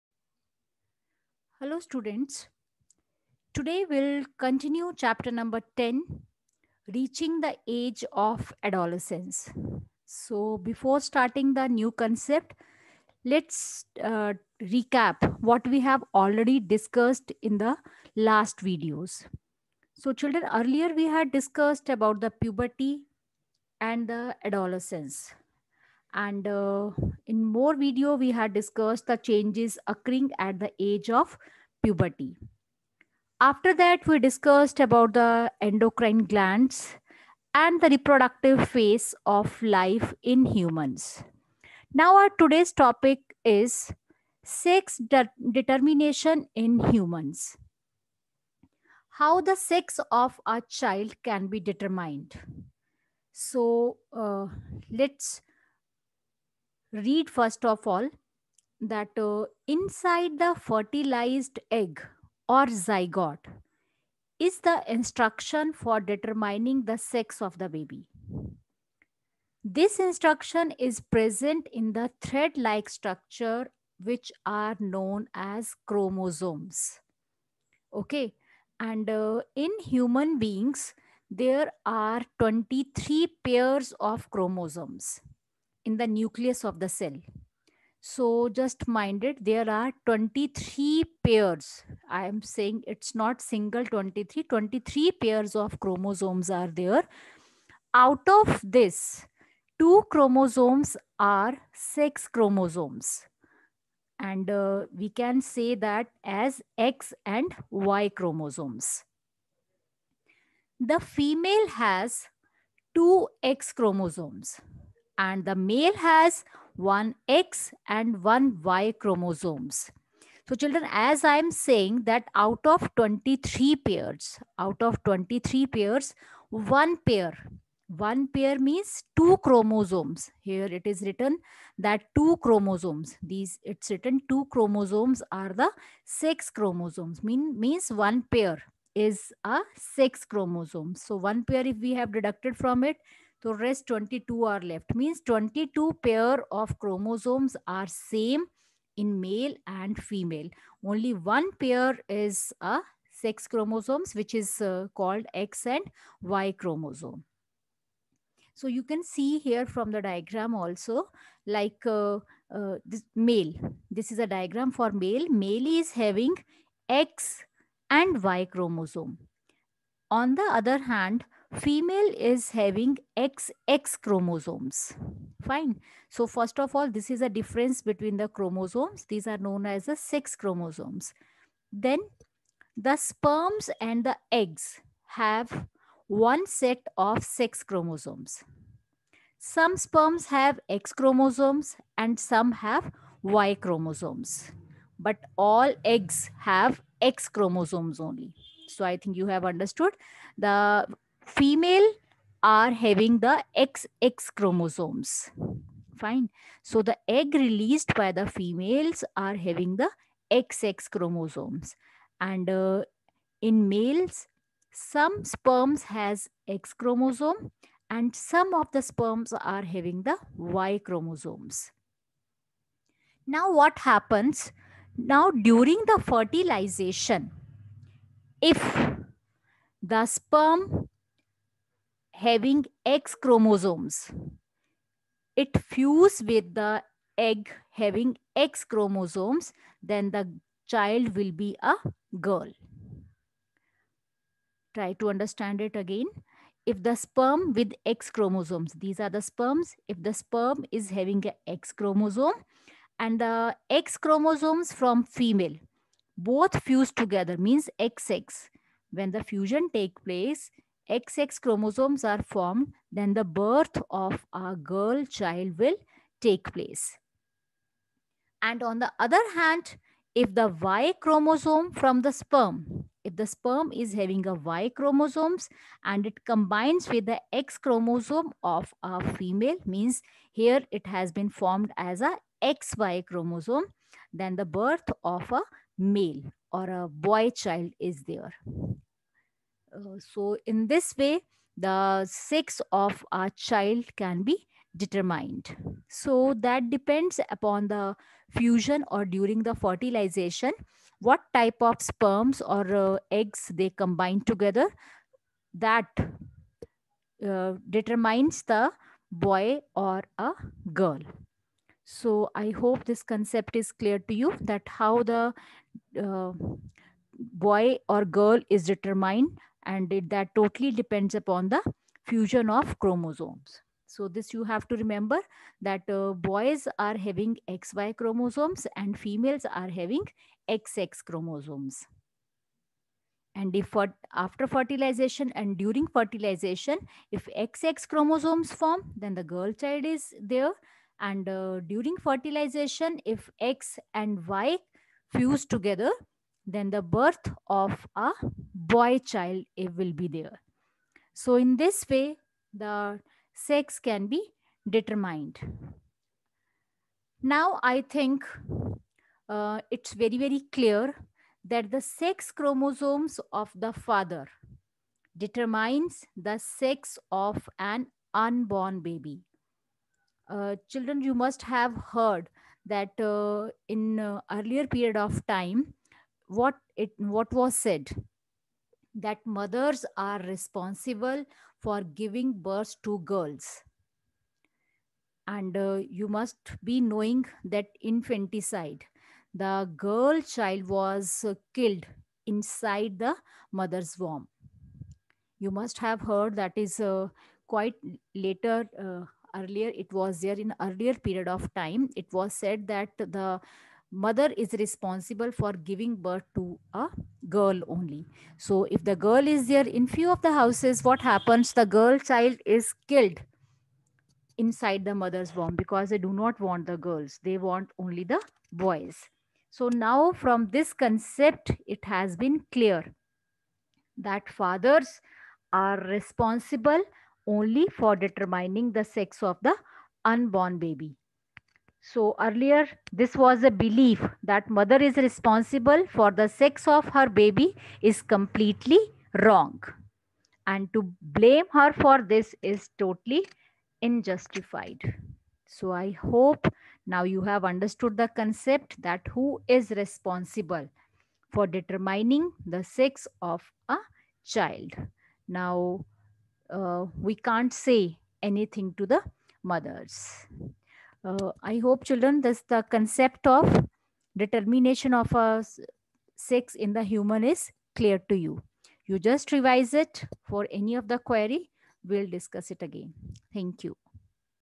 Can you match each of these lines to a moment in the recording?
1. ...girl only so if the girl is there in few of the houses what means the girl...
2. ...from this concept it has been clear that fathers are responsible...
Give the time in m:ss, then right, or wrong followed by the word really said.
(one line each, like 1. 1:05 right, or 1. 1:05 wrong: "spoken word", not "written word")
1. 6:47 wrong: "happens", not "means"
2. 7:00 right.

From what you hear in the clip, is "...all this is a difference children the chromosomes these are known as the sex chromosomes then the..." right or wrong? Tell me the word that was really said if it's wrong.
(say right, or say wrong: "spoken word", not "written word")
wrong: "between", not "children".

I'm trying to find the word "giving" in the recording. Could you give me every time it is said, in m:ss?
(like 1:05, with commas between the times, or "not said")
6:21, 6:45.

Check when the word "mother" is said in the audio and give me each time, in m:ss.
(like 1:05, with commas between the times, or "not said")
6:19, 6:33, 6:43, 6:54, 7:14, 7:39.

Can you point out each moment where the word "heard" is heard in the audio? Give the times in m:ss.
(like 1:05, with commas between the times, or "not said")
6:11, 6:36.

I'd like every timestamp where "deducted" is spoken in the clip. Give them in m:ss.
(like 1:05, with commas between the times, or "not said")
2:22.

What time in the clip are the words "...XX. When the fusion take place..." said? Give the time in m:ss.
4:17.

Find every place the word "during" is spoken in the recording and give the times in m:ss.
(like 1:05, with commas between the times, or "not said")
3:45, 4:59, 5:35, 5:41.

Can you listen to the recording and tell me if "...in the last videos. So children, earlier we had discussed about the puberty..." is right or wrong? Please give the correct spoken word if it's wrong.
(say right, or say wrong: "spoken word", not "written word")
right.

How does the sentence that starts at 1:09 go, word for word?
This instruction is present in the thread like structure which are known as chromosomes.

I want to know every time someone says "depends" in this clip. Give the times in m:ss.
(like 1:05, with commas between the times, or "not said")
4:56, 5:20.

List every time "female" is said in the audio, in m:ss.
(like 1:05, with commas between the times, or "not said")
1:50, 2:30, 2:51, 3:21, 3:28, 4:15, 4:39, 5:28.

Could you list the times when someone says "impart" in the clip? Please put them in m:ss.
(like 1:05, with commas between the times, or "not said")
not said.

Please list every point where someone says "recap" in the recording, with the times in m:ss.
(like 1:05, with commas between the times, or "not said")
0:14.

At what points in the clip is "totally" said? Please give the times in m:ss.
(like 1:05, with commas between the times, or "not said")
5:20, 7:22.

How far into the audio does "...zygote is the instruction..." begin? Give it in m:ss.
1:02.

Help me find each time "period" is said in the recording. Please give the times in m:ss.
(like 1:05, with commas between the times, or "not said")
6:14, 6:41.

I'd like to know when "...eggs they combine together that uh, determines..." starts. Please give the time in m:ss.
5:03.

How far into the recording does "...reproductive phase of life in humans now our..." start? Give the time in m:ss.
0:37.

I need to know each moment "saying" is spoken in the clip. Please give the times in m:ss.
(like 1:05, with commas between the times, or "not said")
1:32, 2:01.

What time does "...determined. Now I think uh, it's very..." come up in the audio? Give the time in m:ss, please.
5:54.